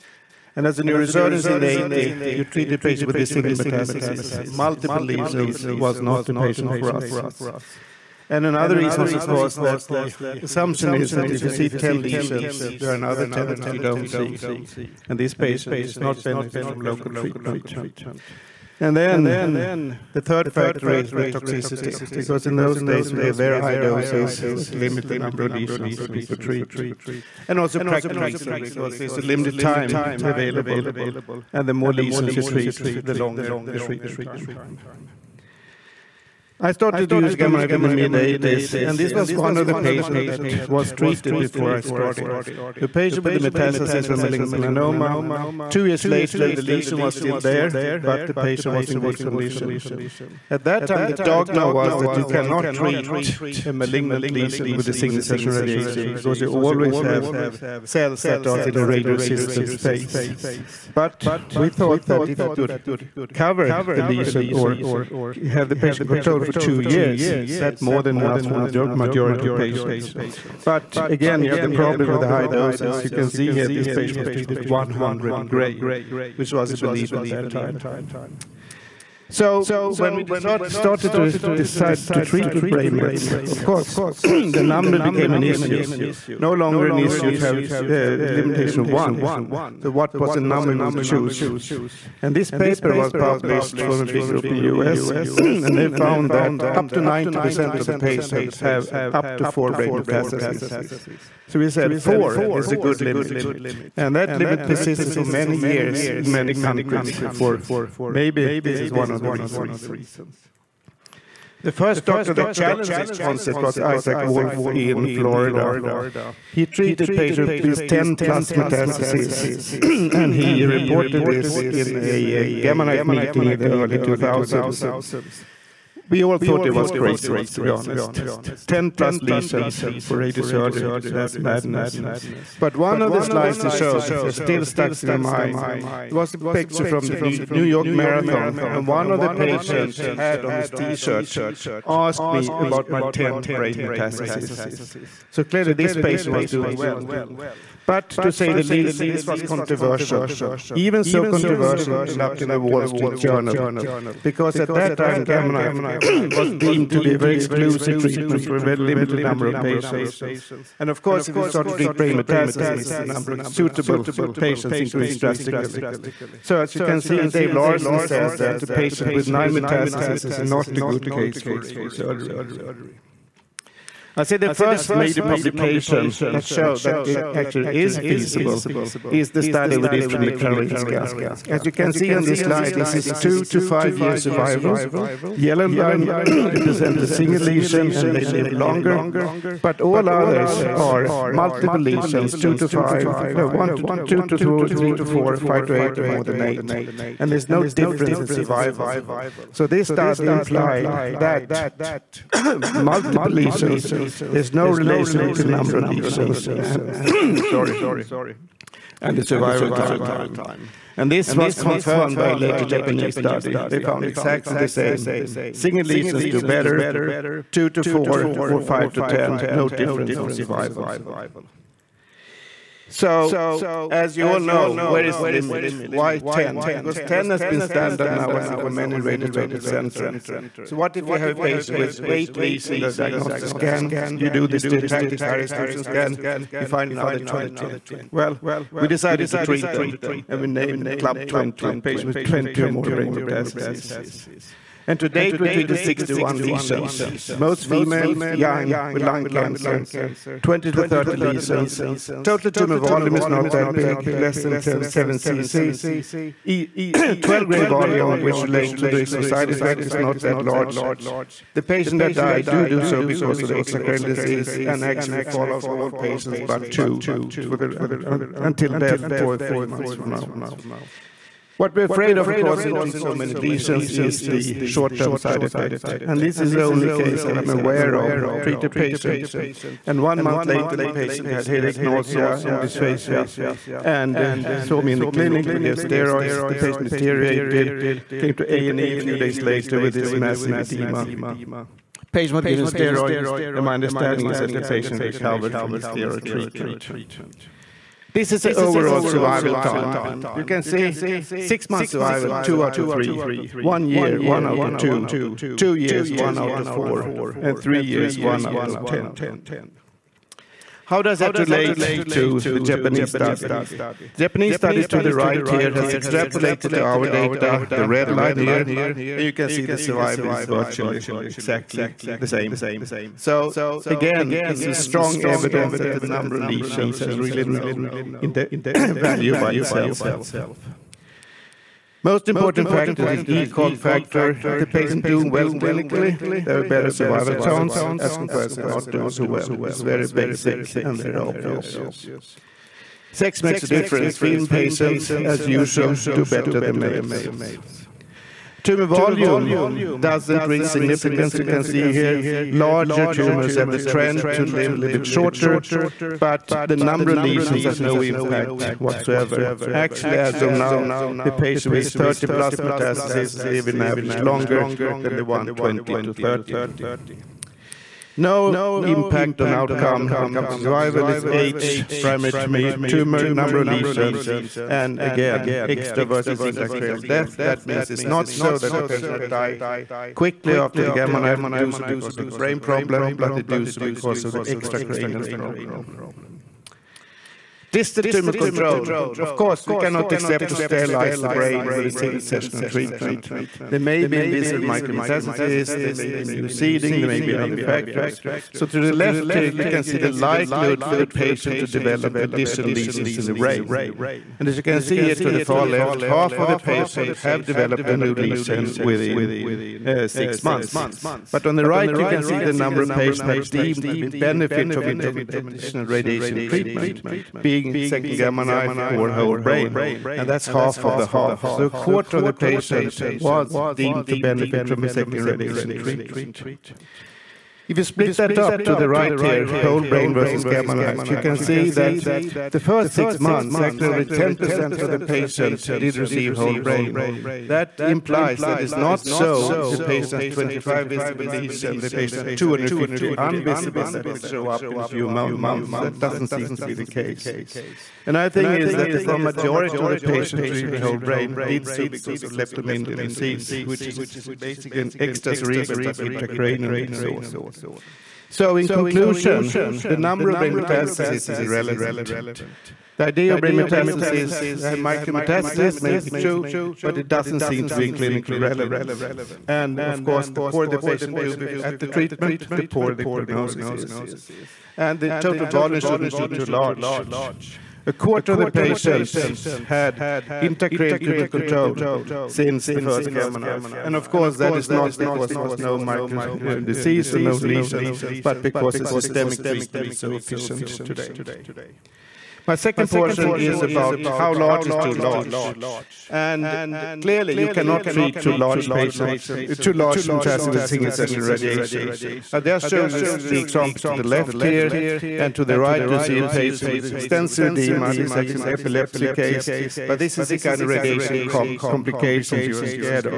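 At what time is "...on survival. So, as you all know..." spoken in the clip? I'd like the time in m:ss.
3:40.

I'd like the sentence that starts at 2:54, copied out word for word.
I say the first major publication that showed that it actually is feasible is the study we did from the Karolinska.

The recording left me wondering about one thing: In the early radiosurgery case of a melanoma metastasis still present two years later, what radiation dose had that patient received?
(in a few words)
100 gray.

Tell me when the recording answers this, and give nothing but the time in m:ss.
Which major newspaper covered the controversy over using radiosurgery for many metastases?
2:32.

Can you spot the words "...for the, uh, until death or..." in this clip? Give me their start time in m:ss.
4:27.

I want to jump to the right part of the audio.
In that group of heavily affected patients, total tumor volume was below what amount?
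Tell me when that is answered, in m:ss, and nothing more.
4:14.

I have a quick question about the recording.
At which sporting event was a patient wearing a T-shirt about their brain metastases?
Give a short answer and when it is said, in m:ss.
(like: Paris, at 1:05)
New York Marathon, at 2:17.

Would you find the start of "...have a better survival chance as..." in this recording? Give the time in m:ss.
5:36.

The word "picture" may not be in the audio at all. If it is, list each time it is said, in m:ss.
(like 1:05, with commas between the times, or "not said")
2:16.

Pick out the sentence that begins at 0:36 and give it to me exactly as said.
I started to use gamma knife in the mid-80s, and this was one of the patients that was treated before I started.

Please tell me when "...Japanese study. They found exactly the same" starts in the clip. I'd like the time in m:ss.
3:32.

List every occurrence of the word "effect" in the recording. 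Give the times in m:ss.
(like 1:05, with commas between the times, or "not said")
4:19, 4:35.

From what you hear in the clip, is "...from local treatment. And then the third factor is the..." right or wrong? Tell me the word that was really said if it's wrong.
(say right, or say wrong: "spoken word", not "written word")
right.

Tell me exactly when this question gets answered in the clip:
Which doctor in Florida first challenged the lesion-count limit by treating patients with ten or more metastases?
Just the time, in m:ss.
1:53.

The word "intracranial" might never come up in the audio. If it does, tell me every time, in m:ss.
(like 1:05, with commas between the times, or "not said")
6:16, 7:35, 8:00.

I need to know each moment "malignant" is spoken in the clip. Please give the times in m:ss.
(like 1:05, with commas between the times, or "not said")
0:44, 0:53.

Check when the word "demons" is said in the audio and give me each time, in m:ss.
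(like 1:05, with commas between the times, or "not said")
not said.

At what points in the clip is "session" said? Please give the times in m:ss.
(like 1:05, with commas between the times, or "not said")
0:55, 6:32, 8:20.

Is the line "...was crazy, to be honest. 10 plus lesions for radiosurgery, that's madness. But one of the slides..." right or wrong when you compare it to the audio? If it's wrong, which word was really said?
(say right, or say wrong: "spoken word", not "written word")
right.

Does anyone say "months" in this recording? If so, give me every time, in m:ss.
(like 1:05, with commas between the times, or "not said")
4:29, 4:40, 5:01, 6:50, 7:13, 7:25.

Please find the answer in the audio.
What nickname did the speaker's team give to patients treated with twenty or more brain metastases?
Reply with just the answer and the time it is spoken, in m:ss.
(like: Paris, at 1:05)
Club 20, at 4:00.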